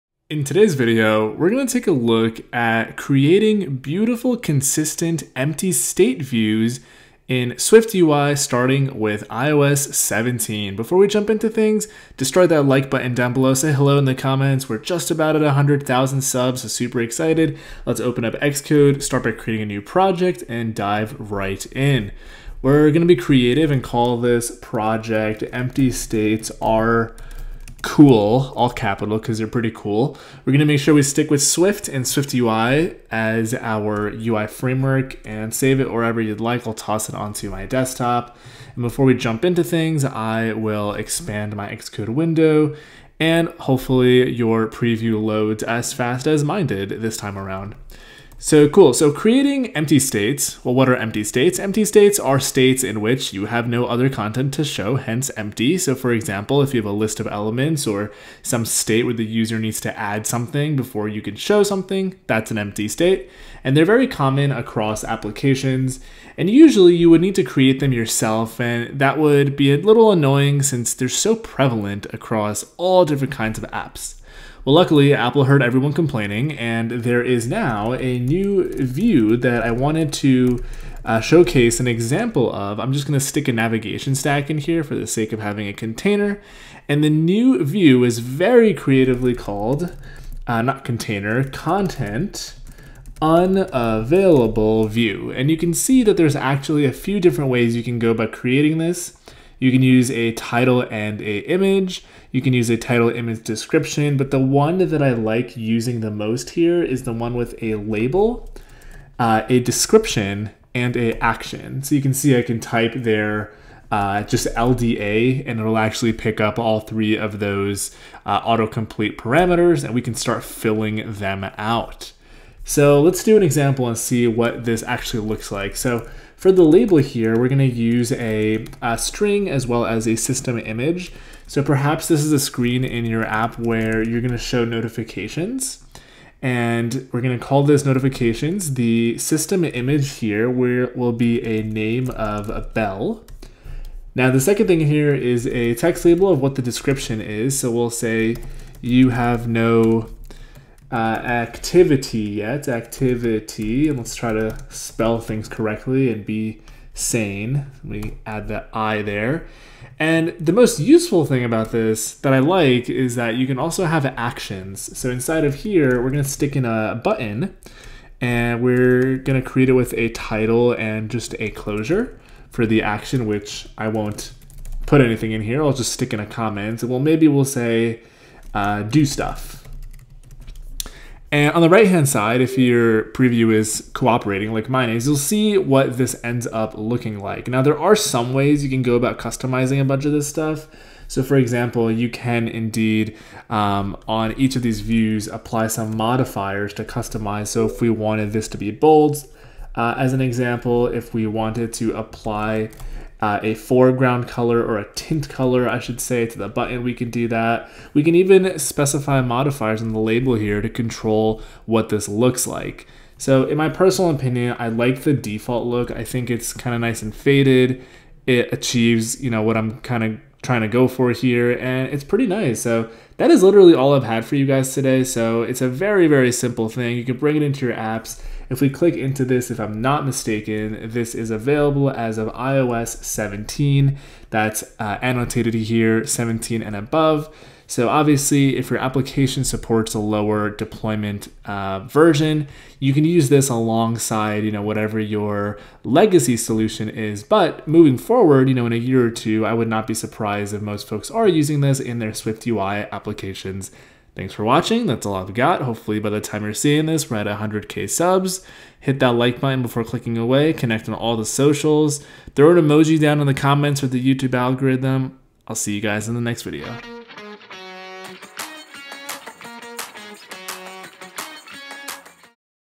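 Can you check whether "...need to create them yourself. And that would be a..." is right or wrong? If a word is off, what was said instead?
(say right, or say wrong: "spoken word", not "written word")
right.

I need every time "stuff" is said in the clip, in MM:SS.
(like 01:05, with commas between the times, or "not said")
02:59, 03:10.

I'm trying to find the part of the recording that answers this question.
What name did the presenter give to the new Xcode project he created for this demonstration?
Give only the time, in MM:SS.
00:25.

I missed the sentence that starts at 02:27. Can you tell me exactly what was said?
So we'll say you have no uh, activity yet.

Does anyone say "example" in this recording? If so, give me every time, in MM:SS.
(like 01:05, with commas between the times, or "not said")
00:56, 01:21, 02:03, 03:11, 03:20.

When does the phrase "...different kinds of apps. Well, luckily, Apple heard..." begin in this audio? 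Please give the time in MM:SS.
01:13.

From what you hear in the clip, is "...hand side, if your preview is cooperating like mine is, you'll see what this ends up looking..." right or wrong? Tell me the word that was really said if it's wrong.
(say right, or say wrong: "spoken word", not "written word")
right.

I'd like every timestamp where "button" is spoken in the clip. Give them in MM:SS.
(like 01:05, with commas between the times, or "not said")
00:12, 02:47, 03:26, 04:19.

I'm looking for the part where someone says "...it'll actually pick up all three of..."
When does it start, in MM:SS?
01:55.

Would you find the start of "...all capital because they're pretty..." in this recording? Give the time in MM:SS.
00:28.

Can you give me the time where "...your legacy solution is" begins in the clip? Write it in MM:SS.
04:04.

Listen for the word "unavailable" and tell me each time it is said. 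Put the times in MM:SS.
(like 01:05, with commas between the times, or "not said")
01:33.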